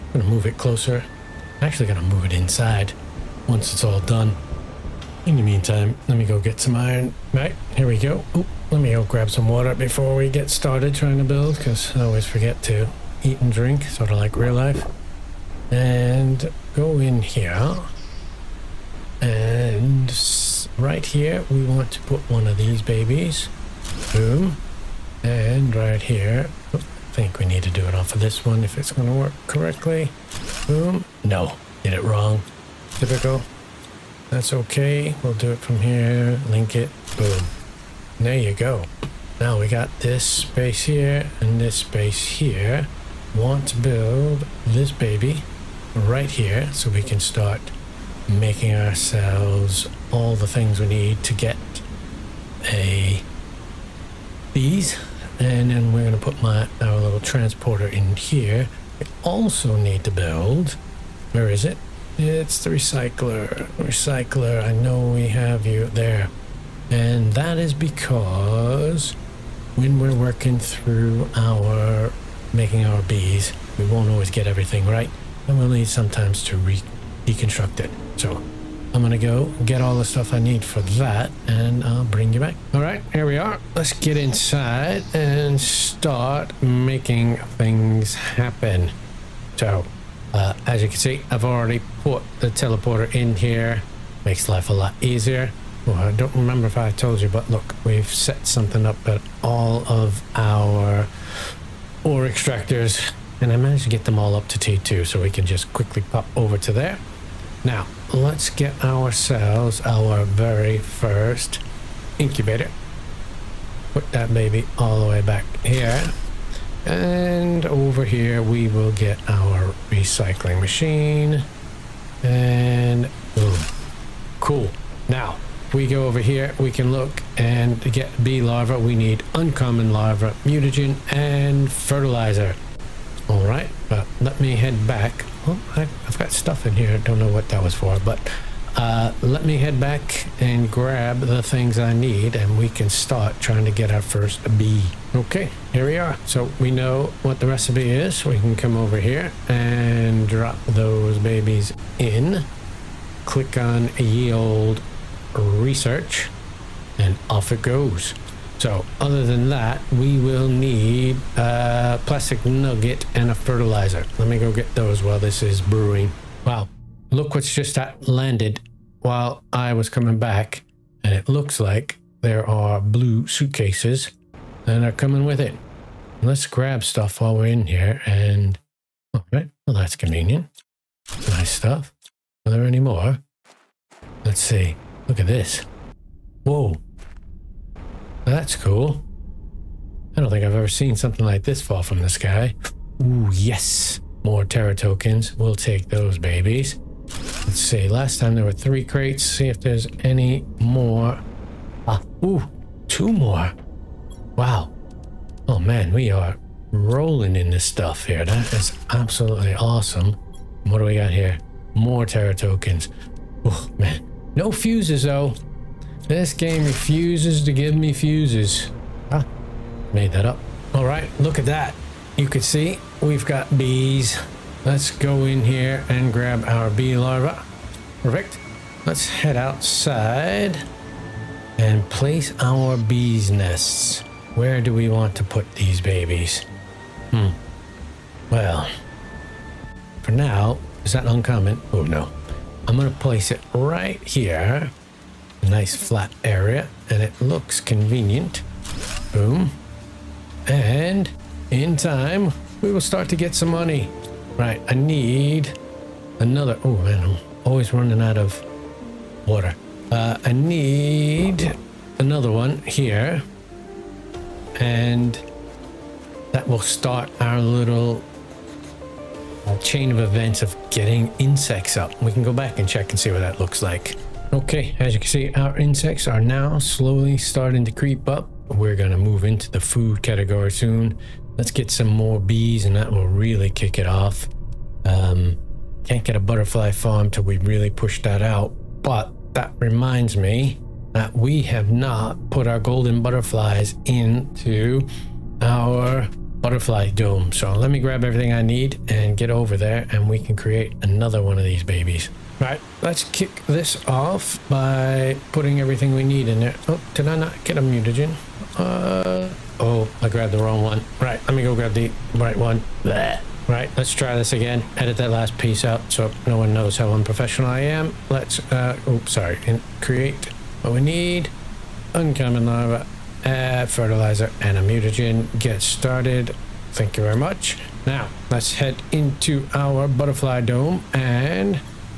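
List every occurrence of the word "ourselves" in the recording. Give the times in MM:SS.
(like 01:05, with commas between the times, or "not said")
00:48, 01:48.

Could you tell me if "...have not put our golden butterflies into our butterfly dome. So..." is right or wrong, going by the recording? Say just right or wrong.
right.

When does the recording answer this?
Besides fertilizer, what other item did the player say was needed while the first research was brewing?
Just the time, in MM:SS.
02:42.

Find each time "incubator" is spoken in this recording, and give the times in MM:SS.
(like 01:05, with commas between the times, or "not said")
01:52.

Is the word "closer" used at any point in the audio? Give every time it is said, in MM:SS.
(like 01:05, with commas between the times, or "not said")
00:00.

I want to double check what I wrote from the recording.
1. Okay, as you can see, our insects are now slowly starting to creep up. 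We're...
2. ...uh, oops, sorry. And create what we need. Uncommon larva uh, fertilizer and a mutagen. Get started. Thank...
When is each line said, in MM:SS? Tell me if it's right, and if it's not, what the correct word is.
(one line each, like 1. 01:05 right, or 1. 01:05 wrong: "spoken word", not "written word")
1. 04:34 right
2. 05:18 right.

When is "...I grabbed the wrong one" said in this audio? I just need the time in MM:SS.
05:10.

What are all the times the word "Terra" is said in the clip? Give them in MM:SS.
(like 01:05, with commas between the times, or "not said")
03:14, 03:32.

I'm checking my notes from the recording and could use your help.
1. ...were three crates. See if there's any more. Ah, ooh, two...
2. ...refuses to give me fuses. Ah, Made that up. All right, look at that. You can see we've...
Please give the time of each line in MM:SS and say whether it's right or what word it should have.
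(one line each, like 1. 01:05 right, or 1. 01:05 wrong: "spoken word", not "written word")
1. 03:18 right
2. 03:36 right.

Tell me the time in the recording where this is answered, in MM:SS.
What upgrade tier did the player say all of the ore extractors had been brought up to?
01:44.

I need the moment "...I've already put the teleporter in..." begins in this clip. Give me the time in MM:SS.
01:31.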